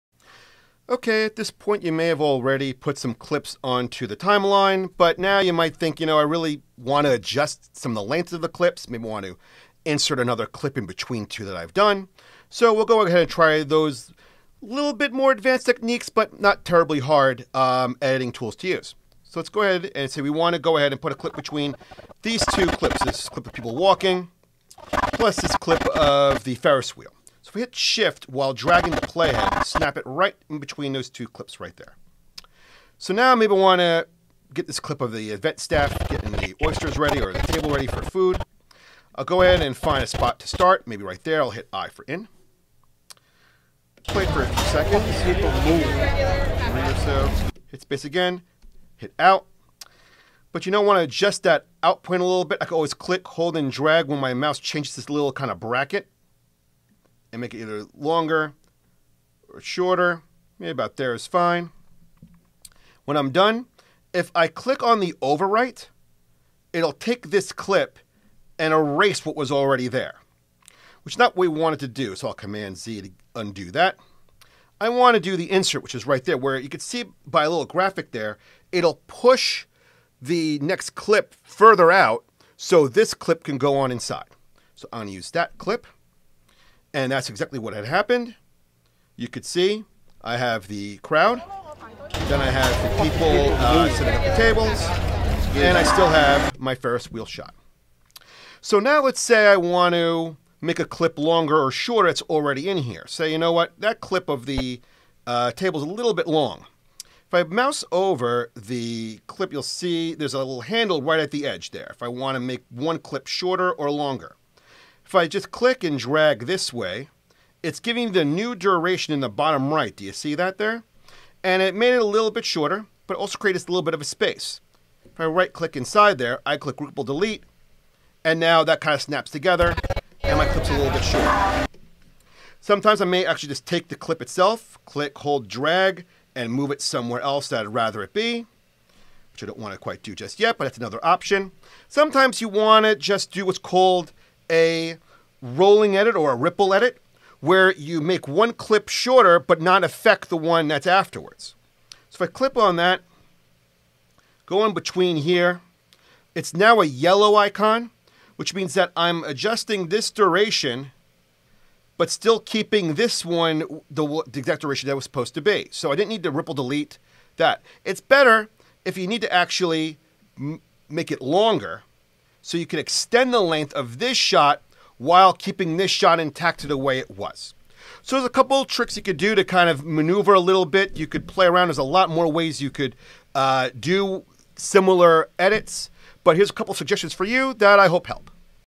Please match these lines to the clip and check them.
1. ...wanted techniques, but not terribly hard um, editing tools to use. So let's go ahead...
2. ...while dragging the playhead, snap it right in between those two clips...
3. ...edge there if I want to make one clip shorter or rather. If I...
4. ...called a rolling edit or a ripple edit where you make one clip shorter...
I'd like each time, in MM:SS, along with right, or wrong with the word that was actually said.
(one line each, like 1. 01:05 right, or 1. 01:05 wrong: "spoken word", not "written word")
1. 00:15 wrong: "advanced", not "wanted"
2. 00:28 right
3. 01:51 wrong: "longer", not "rather"
4. 02:23 right.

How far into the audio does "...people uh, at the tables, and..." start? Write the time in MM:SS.
01:33.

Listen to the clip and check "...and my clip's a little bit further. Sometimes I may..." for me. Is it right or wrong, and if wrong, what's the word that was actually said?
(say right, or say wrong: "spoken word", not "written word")
wrong: "shorter", not "further".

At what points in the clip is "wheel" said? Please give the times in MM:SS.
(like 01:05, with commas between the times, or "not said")
00:26, 01:37.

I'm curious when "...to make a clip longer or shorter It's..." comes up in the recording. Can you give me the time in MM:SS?
01:39.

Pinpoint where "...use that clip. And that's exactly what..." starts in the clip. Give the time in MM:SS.
01:25.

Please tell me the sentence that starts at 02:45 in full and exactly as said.
So I didn't need to ripple delete that.